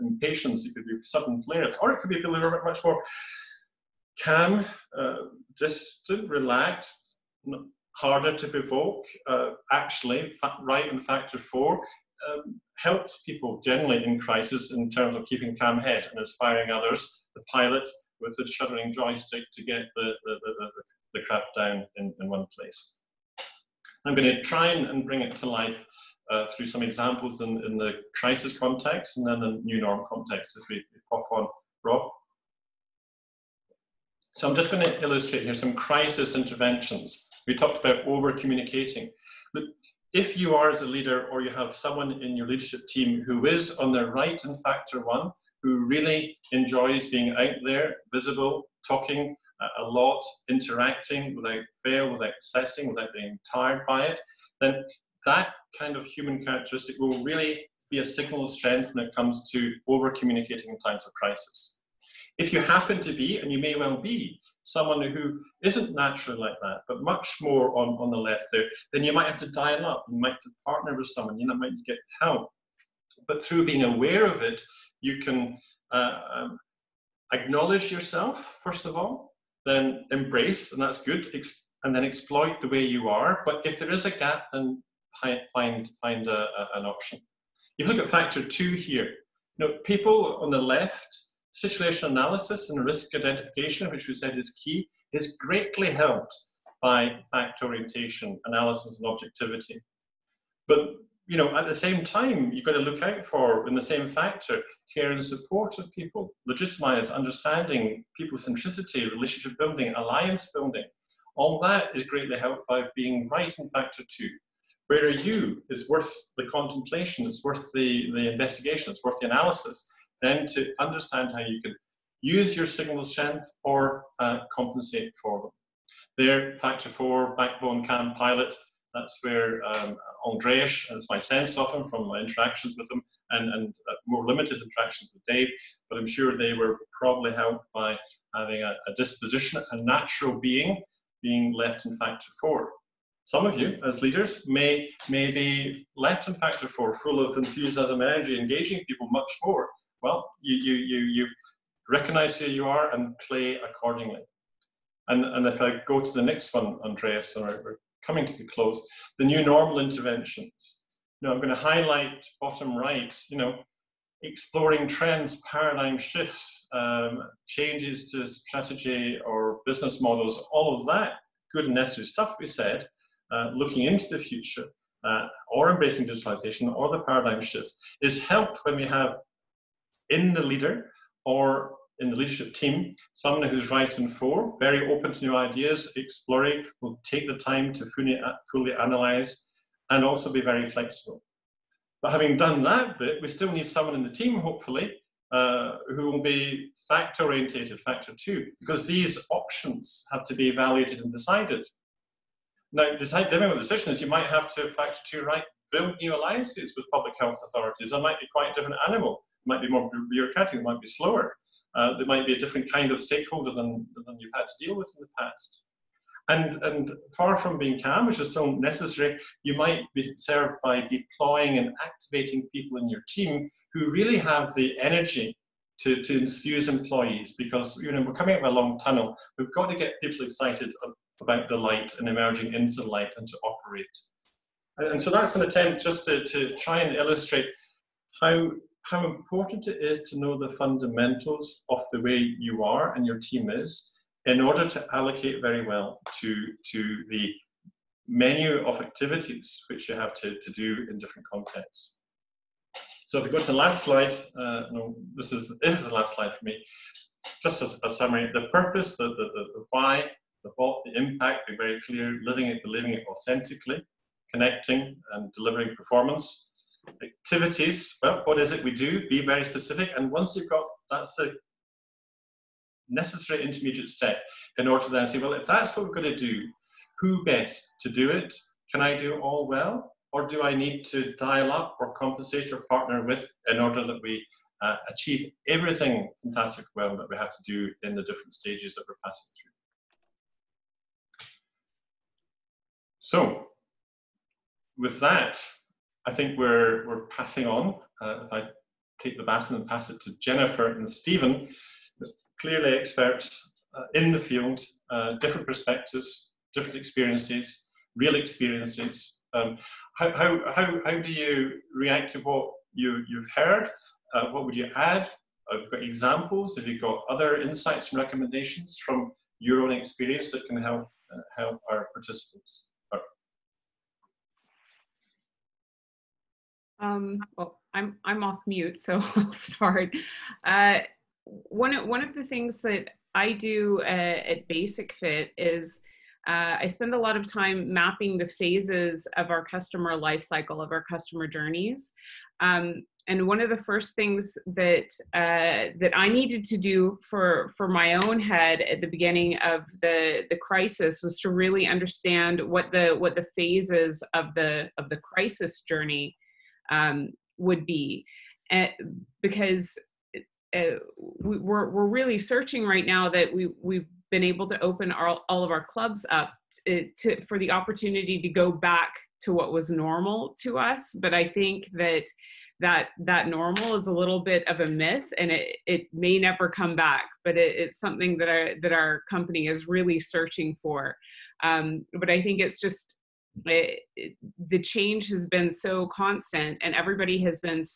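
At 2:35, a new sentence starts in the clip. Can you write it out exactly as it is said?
And, and if I go to the next one, Andreas, and we're coming to the close, the new normal interventions.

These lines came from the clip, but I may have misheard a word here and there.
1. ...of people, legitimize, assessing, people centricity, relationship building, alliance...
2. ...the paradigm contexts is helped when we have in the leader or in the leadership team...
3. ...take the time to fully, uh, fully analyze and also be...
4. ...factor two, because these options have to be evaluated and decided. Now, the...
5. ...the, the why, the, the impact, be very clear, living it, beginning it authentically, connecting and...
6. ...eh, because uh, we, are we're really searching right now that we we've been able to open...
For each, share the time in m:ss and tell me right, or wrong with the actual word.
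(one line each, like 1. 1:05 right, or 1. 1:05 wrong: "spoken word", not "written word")
1. 1:45 wrong: "understanding", not "assessing"
2. 2:56 wrong: "shifts", not "contexts"
3. 3:07 right
4. 3:17 right
5. 4:19 wrong: "believing", not "beginning"
6. 5:58 right.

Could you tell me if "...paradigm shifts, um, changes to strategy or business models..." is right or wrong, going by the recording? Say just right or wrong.
right.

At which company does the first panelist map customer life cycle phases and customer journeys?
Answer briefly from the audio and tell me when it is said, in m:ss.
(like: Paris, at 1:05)
Basic-Fit, at 5:34.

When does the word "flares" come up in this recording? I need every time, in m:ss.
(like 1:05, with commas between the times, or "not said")
0:01.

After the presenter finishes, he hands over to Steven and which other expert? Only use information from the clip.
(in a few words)
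Jenifer.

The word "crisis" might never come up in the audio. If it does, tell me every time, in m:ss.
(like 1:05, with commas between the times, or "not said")
0:14, 0:28, 0:35, 1:01, 5:50, 5:54.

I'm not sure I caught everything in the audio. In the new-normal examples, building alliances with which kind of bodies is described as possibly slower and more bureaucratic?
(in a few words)
public health authorities.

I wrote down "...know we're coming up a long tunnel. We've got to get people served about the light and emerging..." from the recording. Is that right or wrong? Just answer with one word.
wrong.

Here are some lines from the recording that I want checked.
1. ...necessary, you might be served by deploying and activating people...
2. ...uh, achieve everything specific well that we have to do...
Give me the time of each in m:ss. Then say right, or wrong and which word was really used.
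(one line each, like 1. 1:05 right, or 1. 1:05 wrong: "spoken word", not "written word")
1. 3:38 right
2. 4:44 wrong: "fantastic", not "specific".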